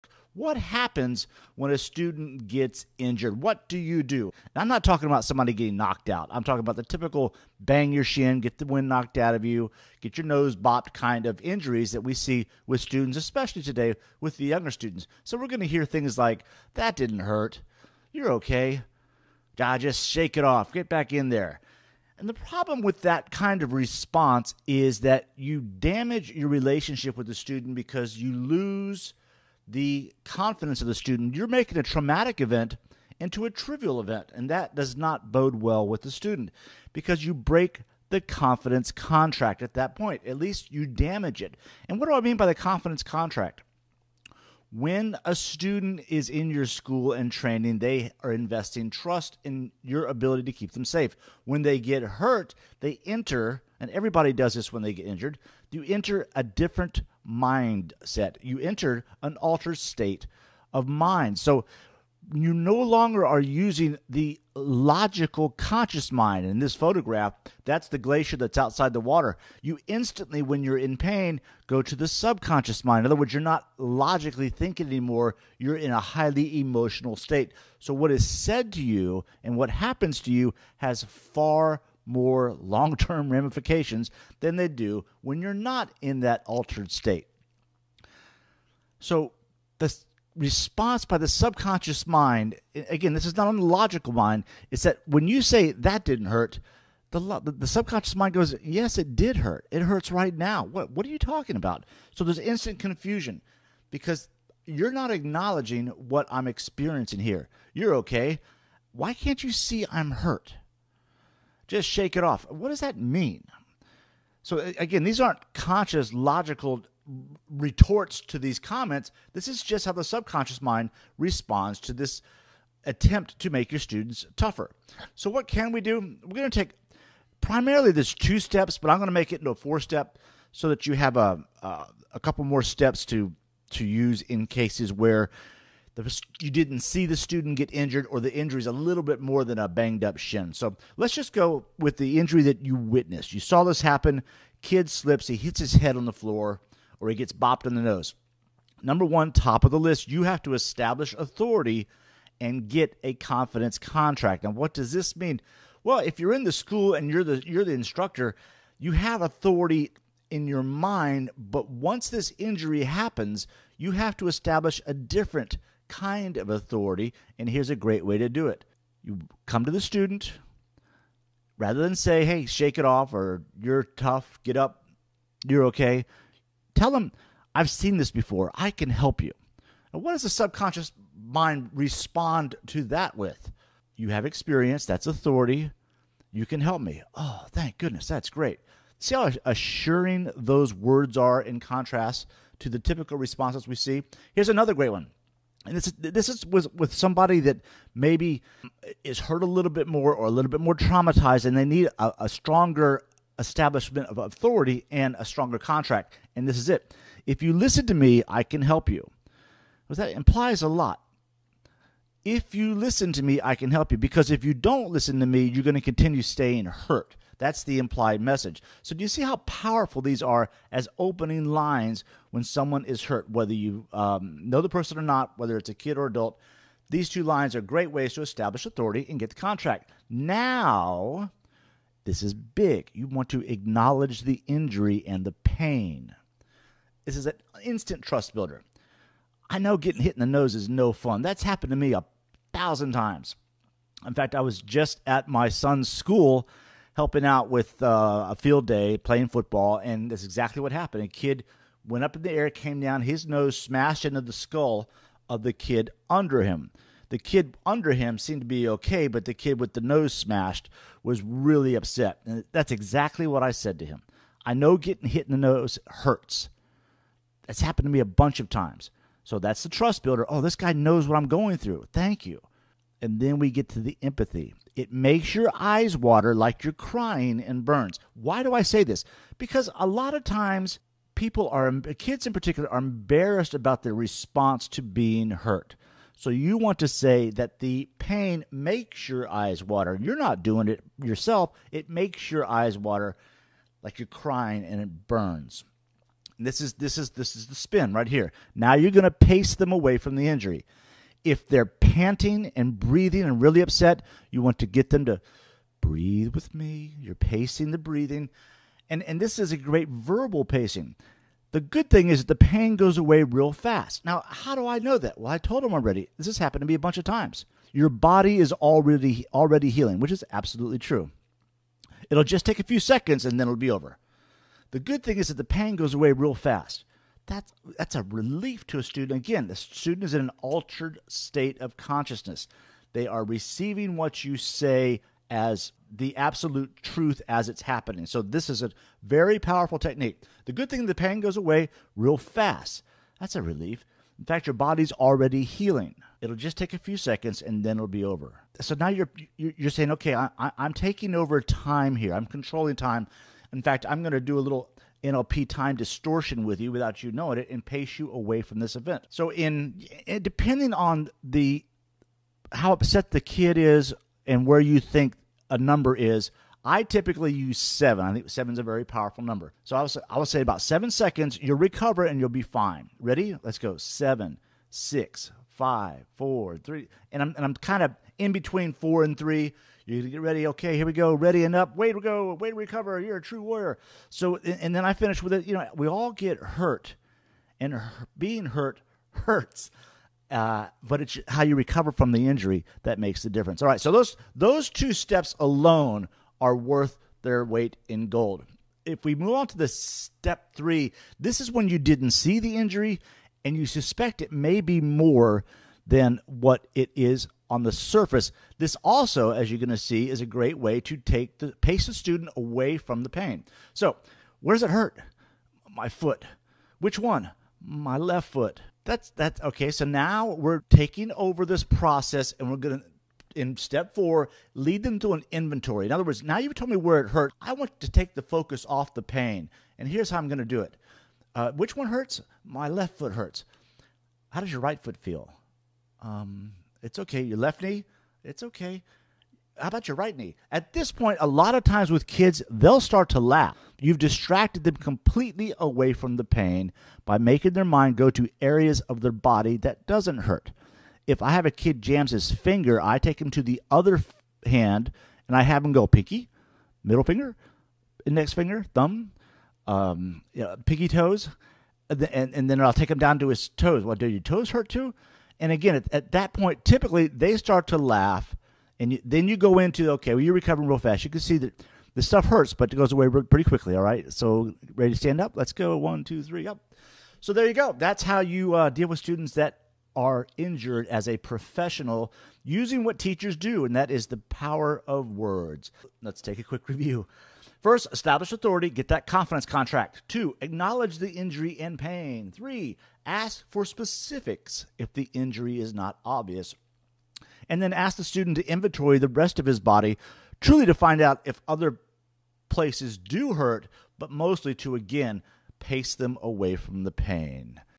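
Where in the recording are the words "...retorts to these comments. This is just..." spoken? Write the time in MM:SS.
01:57.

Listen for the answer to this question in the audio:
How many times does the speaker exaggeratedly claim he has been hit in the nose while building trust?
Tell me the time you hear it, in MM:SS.
04:02.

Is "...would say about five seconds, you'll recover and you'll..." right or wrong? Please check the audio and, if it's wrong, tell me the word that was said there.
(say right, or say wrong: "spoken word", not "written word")
wrong: "seven", not "five".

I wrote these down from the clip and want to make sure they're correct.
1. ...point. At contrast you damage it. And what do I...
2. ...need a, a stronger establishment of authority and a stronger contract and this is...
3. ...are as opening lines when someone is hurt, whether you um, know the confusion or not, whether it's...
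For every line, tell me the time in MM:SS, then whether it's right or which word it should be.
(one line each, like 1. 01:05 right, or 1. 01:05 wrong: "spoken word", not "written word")
1. 00:39 wrong: "least", not "contrast"
2. 03:21 right
3. 03:40 wrong: "person", not "confusion".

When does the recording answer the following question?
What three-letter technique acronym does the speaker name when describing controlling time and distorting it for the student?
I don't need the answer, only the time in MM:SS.
05:55.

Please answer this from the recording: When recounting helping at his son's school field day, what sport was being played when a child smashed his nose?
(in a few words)
football.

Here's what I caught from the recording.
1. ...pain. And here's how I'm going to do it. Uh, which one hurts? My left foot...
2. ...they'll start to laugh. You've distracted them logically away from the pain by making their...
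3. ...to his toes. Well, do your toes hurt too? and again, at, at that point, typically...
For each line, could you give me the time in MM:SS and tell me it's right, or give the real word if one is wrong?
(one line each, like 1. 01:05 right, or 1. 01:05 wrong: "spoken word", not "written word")
1. 07:09 right
2. 07:22 wrong: "completely", not "logically"
3. 07:43 right.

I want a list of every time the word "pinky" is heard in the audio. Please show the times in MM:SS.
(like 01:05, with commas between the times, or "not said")
07:35, 07:40.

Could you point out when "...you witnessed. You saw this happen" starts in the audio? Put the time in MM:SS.
02:22.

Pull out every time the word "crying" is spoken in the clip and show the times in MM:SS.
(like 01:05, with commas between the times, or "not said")
04:36, 04:54.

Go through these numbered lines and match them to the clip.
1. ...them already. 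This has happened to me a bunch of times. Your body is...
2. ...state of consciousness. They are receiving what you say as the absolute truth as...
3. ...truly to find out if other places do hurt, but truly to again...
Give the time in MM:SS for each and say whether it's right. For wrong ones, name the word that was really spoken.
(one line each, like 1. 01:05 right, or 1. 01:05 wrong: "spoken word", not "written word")
1. 05:15 right
2. 05:31 right
3. 08:20 wrong: "mostly", not "truly".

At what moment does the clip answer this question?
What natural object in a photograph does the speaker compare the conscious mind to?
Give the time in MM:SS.
01:07.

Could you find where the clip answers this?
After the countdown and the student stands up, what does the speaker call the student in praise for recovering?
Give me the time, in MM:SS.
06:23.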